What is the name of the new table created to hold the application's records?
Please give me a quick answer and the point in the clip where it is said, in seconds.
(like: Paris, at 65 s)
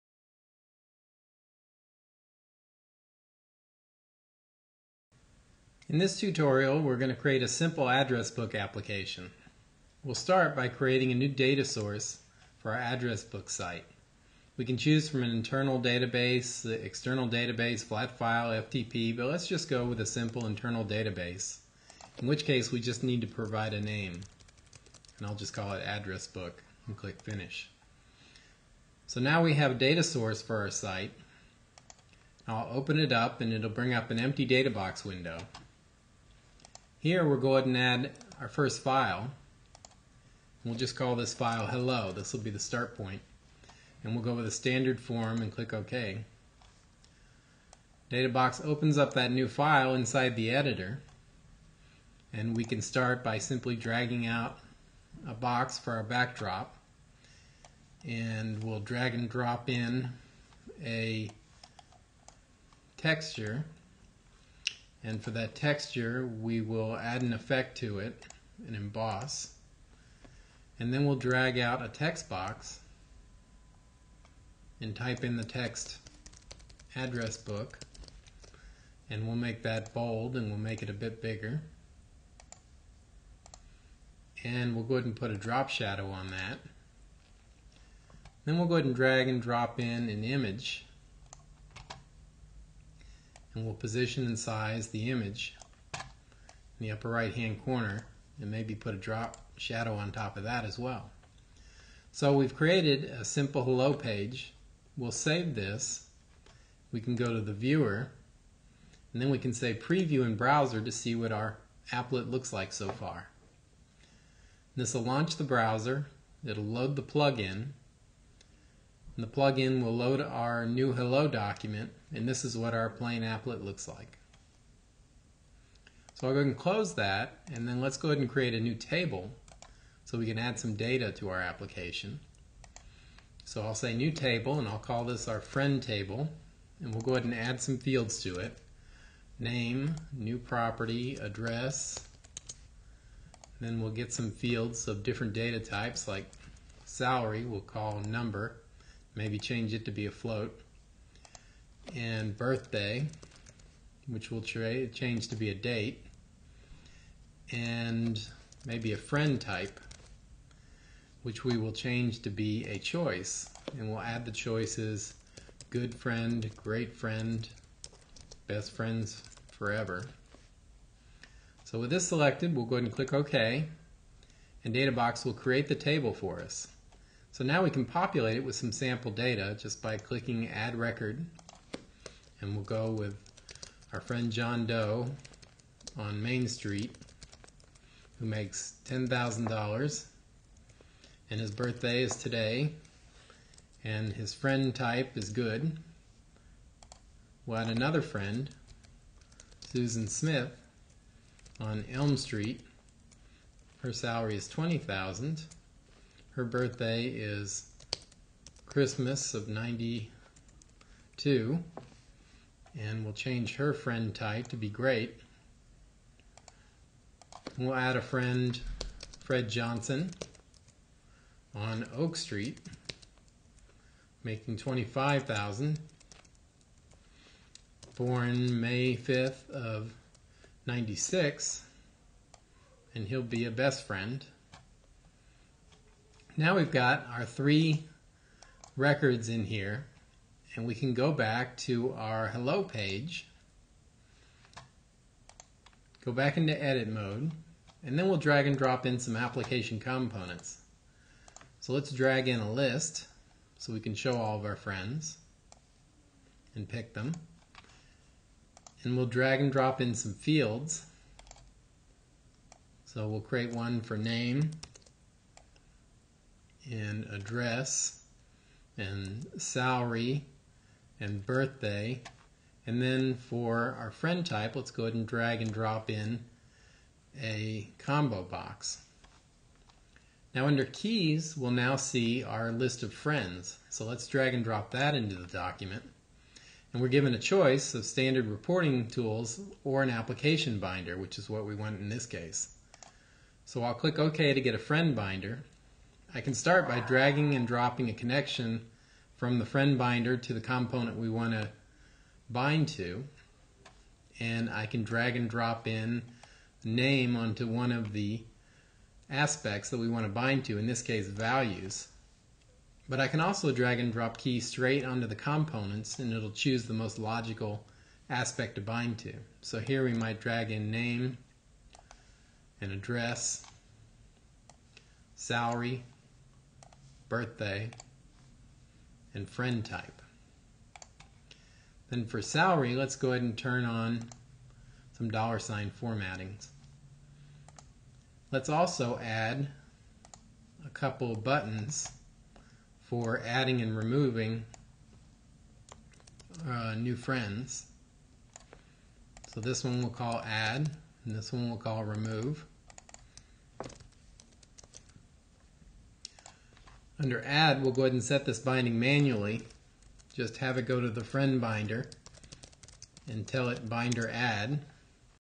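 friend table, at 135 s.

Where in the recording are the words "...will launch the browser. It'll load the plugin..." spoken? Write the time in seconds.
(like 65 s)
114 s.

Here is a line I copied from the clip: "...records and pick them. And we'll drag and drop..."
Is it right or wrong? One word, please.
wrong.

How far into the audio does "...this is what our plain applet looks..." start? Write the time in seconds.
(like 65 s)
122 s.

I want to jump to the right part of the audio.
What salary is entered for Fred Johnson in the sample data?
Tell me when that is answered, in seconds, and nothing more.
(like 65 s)
224 s.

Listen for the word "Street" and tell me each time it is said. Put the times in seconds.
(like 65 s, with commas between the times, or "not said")
186 s, 202 s, 222 s.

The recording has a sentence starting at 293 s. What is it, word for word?
So I'll click OK to get a friend binder.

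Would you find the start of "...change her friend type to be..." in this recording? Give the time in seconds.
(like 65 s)
213 s.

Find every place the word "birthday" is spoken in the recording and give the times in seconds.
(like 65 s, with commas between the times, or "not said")
152 s, 191 s, 206 s, 271 s, 327 s.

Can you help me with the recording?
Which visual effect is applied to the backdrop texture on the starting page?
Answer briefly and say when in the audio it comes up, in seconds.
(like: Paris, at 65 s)
emboss, at 68 s.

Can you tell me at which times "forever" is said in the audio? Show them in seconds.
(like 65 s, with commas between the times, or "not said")
169 s.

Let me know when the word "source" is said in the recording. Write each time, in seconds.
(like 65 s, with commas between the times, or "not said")
11 s, 30 s.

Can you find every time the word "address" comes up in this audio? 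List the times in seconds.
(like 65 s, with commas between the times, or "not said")
7 s, 12 s, 25 s, 76 s, 141 s, 267 s, 322 s.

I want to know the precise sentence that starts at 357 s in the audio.
Under add, we'll go ahead and set this binding manually.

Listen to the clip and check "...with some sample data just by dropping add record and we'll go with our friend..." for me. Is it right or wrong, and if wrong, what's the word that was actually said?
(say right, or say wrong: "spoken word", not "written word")
wrong: "clicking", not "dropping".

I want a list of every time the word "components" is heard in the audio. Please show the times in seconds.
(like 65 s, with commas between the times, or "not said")
249 s, 300 s, 315 s.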